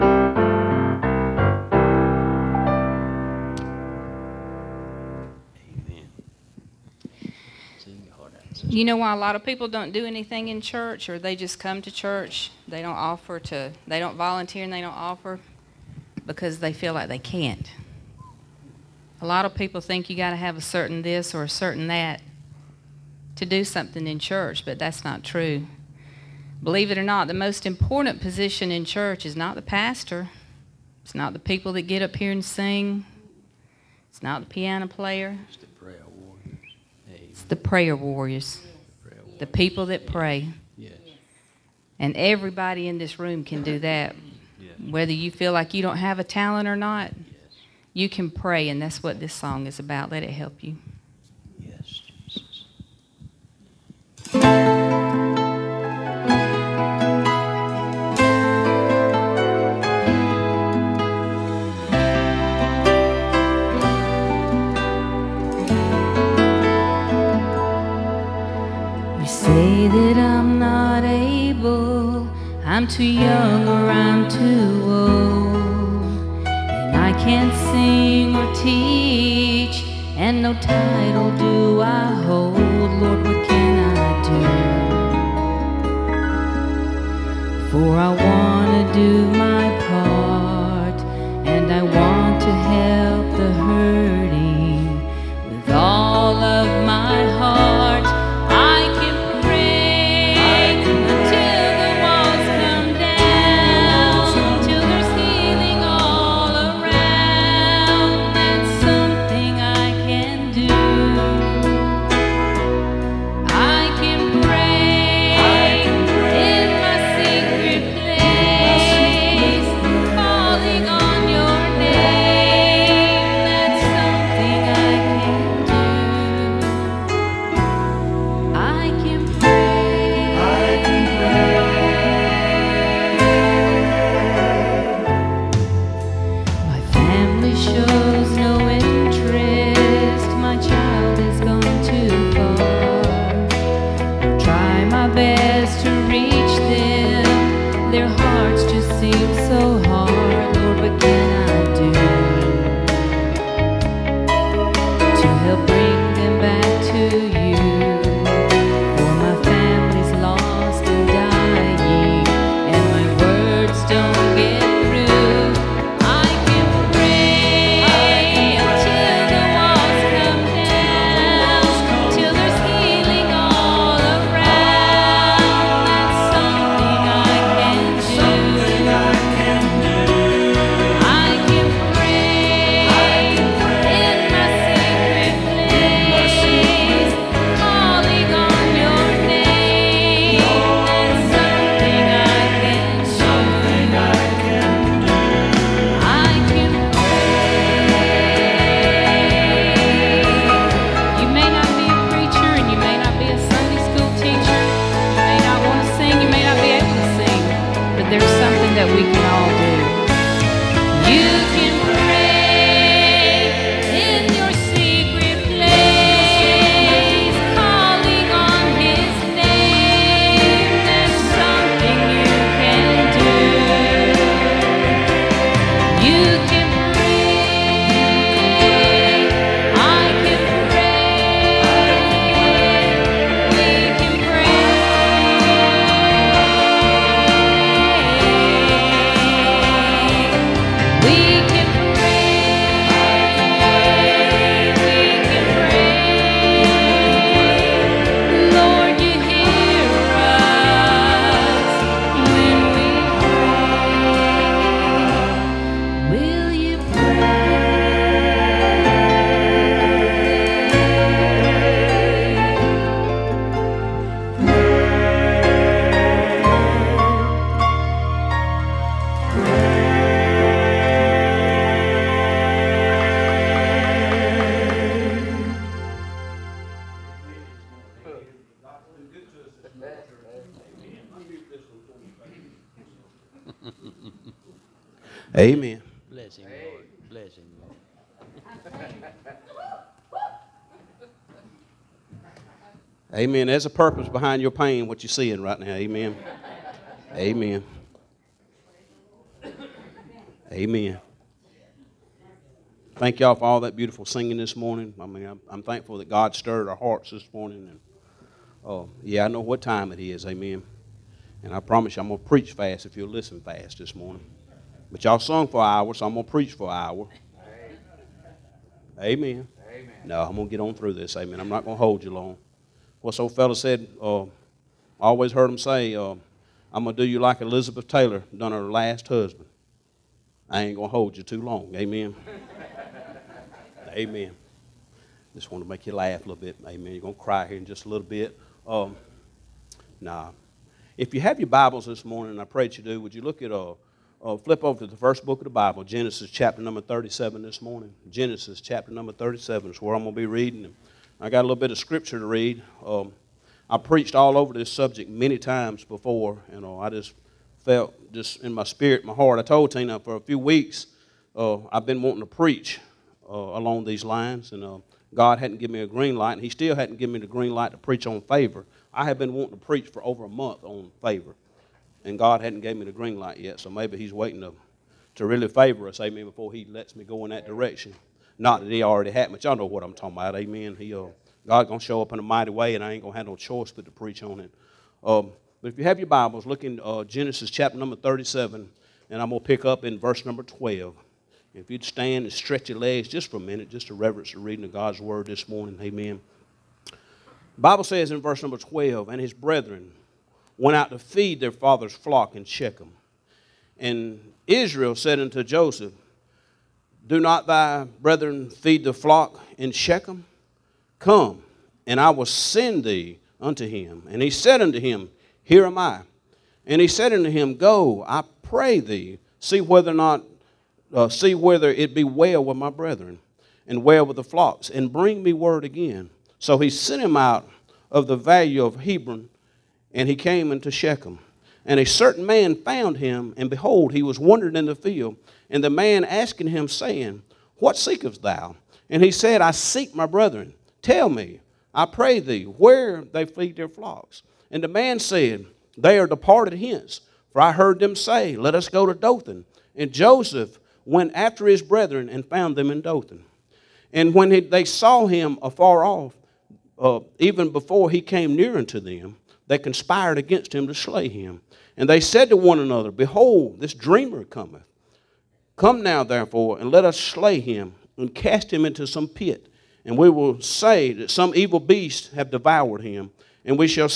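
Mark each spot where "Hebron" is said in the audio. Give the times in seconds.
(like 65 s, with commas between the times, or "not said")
428 s.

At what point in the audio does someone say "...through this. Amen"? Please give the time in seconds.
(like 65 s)
320 s.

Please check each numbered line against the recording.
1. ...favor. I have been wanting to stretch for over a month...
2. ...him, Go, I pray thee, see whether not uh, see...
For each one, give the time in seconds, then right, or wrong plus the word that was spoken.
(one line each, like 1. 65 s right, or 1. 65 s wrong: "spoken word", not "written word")
1. 368 s wrong: "preach", not "stretch"
2. 417 s right.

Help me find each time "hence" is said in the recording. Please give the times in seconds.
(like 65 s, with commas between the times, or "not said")
446 s.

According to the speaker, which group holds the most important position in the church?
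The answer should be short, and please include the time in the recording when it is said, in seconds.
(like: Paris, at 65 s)
prayer warriors, at 37 s.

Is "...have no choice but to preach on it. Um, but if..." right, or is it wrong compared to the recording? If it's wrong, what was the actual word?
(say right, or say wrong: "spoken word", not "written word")
right.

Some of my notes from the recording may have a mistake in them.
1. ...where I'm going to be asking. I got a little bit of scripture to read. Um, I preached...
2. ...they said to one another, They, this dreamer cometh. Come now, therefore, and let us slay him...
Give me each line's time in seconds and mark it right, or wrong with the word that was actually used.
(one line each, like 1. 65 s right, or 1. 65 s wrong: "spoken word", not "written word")
1. 349 s wrong: "reading", not "asking"
2. 461 s wrong: "Behold", not "They".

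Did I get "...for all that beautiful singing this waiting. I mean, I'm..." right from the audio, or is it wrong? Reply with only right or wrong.
wrong.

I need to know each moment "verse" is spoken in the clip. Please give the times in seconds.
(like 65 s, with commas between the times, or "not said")
389 s, 398 s.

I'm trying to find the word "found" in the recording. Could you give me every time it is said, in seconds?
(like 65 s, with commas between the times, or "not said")
432 s, 452 s.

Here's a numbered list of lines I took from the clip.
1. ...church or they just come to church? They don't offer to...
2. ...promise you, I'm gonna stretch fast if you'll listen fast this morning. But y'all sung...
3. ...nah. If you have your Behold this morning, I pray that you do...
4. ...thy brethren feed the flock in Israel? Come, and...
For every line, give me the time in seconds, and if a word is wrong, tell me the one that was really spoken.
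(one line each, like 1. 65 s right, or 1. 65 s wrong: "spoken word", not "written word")
1. 10 s right
2. 311 s wrong: "preach", not "stretch"
3. 339 s wrong: "Bibles", not "Behold"
4. 407 s wrong: "Shechem", not "Israel".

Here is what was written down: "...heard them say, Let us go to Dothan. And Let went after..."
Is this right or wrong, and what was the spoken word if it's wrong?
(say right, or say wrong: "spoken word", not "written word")
wrong: "Joseph", not "Let".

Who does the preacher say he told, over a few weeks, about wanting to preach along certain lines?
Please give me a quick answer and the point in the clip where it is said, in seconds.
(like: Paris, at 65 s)
Tina, at 359 s.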